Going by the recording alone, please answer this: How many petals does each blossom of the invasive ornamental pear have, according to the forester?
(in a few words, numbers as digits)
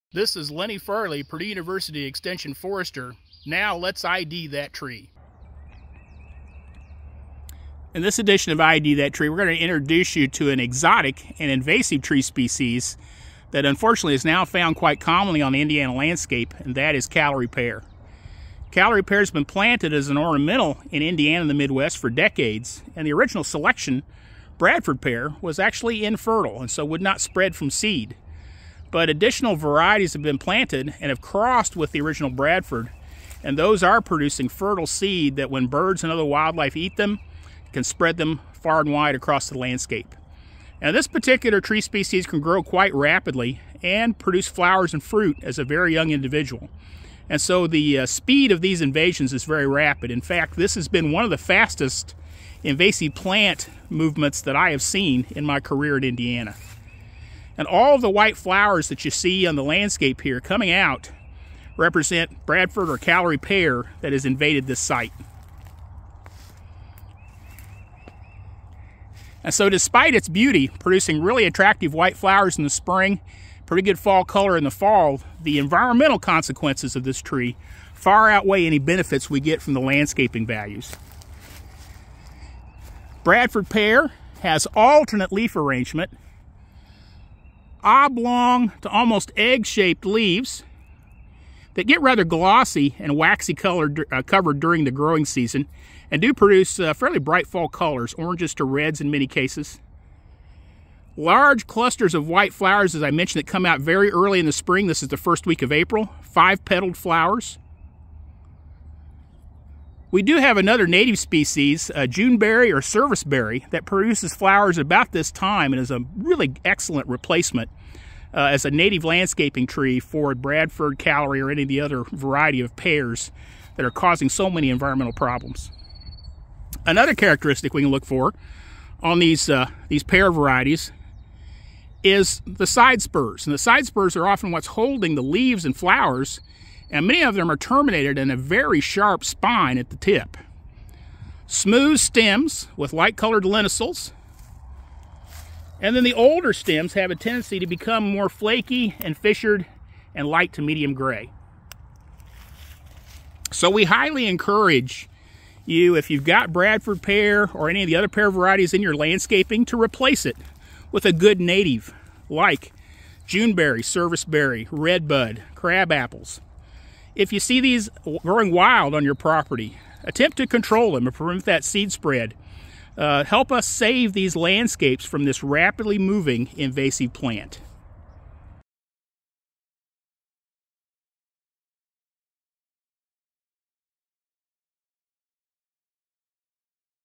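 5.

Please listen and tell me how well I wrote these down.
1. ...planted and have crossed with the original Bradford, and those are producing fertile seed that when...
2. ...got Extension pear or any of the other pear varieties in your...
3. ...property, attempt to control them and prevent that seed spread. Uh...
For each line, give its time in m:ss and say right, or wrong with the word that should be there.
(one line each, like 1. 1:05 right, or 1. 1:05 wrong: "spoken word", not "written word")
1. 0:30 right
2. 2:36 wrong: "Bradford", not "Extension"
3. 2:49 right.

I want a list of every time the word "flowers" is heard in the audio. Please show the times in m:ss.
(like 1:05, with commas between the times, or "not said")
0:44, 0:58, 1:12, 1:42, 1:46, 1:54, 2:15.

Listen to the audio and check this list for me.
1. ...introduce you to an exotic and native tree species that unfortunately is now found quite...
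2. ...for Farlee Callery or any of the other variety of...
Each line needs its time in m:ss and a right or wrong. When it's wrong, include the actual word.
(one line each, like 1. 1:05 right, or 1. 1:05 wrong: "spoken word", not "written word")
1. 0:09 wrong: "invasive", not "native"
2. 2:00 wrong: "Bradford", not "Farlee".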